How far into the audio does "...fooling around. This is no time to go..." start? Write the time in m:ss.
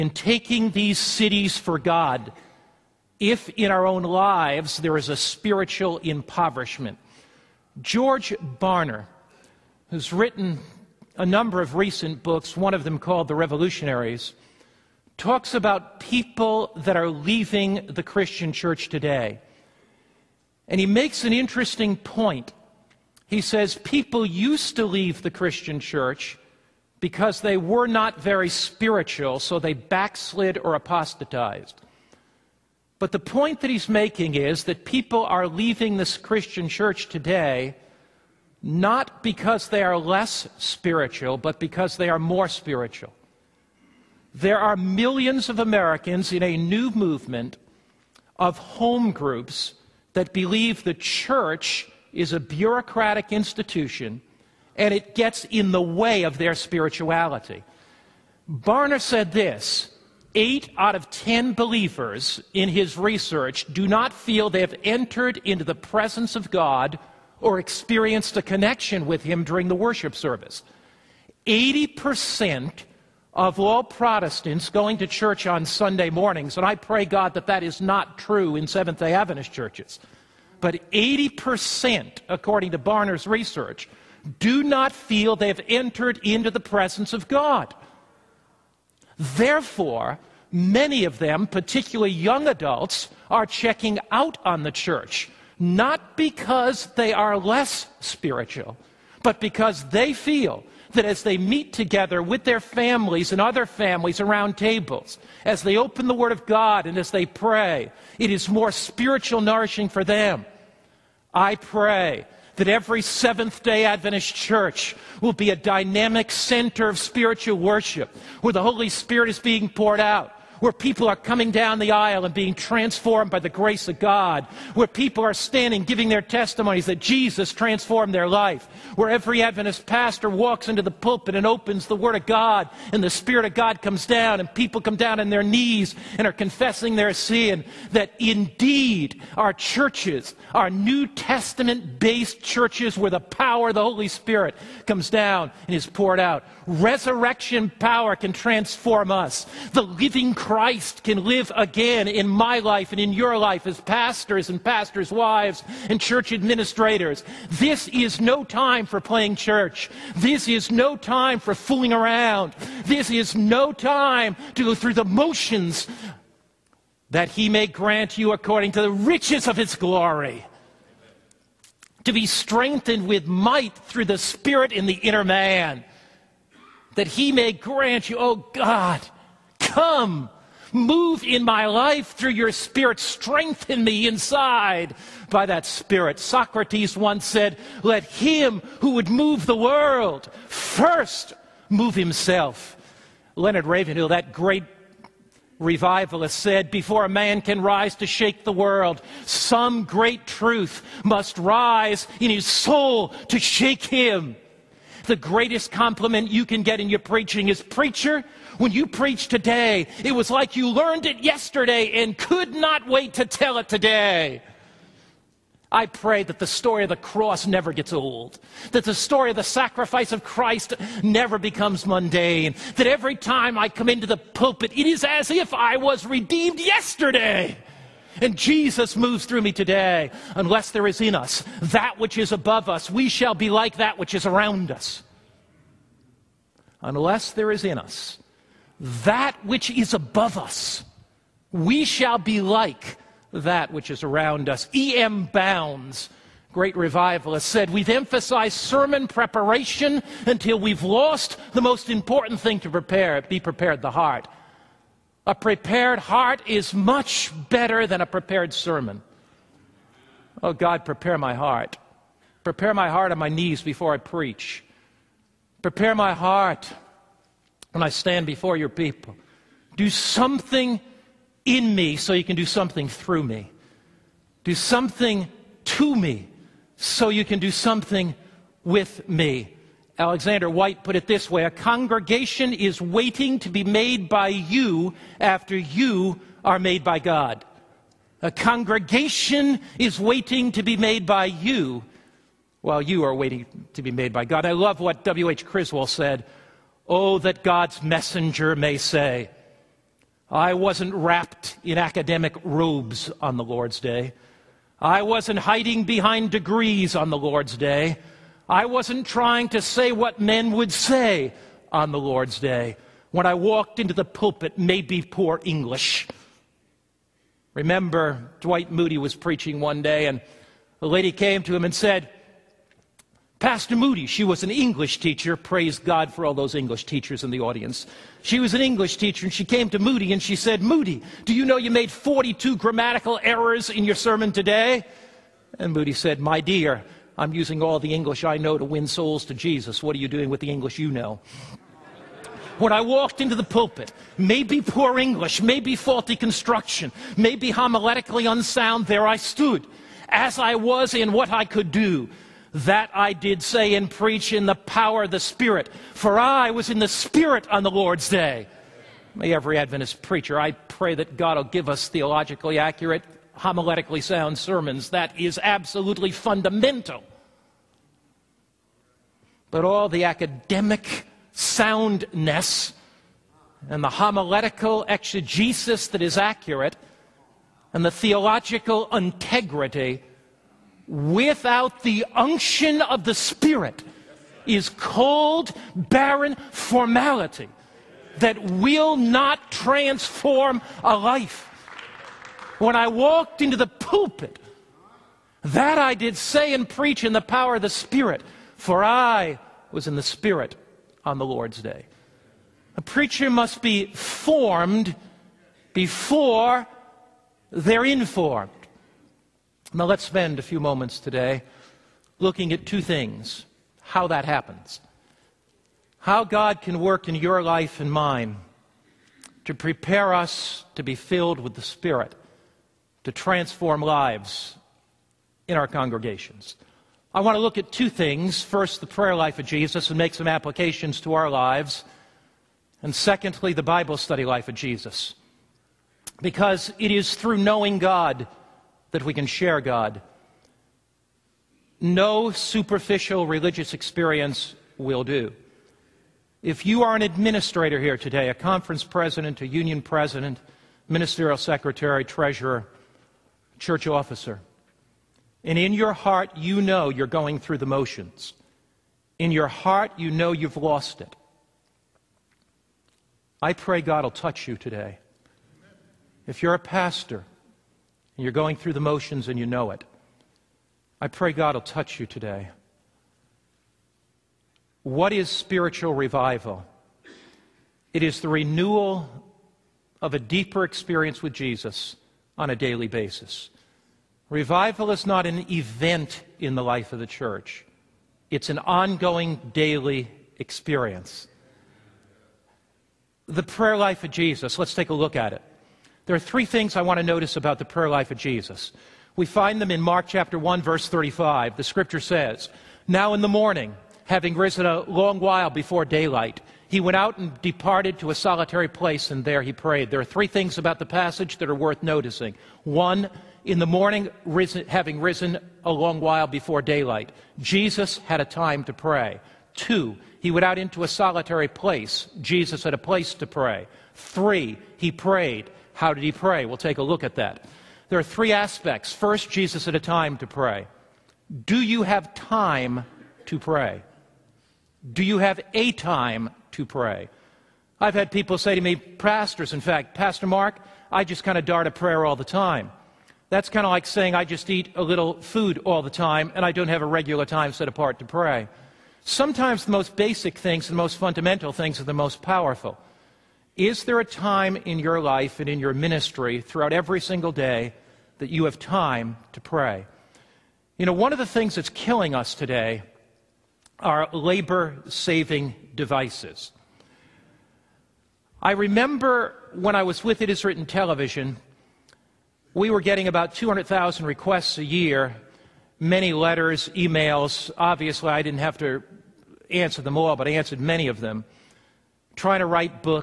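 2:41.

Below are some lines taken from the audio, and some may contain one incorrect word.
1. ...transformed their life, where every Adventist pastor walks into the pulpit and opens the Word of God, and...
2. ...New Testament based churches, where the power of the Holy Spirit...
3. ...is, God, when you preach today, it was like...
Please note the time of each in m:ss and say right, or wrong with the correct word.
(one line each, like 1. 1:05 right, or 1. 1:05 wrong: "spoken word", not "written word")
1. 2:07 right
2. 2:20 right
3. 3:27 wrong: "Preacher", not "God".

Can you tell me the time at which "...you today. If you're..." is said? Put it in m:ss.
7:44.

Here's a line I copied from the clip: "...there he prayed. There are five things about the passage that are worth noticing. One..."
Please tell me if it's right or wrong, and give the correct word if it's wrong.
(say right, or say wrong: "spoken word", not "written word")
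wrong: "three", not "five".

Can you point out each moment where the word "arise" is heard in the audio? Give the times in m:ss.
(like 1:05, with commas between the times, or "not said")
not said.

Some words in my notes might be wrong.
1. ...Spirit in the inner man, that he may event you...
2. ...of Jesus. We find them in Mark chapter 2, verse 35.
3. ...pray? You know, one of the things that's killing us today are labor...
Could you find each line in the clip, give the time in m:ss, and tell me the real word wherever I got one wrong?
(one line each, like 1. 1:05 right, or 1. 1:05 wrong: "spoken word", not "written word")
1. 2:54 wrong: "grant", not "event"
2. 8:18 wrong: "1", not "2"
3. 9:19 right.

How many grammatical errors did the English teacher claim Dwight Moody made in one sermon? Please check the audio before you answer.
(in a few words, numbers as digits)
42.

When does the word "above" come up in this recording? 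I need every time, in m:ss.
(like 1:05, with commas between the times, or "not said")
3:52, 3:59.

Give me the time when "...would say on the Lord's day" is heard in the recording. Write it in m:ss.
5:10.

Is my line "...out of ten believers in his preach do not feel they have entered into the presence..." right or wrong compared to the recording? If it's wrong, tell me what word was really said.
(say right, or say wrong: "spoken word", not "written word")
wrong: "research", not "preach".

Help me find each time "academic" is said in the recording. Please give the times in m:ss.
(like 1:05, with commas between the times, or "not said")
5:01, 6:10.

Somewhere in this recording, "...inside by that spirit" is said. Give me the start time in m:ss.
3:04.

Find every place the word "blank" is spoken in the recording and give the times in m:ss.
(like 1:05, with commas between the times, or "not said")
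not said.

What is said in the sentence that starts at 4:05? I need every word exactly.
Bounds, great revivalist, said, We've emphasized sermon preparation until we've lost the most important thing to prepare be prepared the heart.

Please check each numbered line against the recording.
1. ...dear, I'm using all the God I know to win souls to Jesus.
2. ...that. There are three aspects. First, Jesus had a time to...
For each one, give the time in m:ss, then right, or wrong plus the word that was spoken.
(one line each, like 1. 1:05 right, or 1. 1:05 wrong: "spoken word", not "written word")
1. 5:36 wrong: "English", not "God"
2. 8:47 right.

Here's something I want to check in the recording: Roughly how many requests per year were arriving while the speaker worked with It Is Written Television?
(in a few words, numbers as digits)
200,000.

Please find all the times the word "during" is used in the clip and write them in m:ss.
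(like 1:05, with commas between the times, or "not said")
1:09.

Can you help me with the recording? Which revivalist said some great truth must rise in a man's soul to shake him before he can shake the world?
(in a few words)
Leonard Ravenhill.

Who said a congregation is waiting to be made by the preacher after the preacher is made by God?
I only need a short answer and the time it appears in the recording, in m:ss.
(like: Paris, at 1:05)
Alexander Whyte, at 4:39.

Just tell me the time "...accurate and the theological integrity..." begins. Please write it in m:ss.
6:16.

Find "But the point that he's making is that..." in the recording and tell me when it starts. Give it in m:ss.
0:32.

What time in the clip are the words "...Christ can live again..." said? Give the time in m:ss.
2:30.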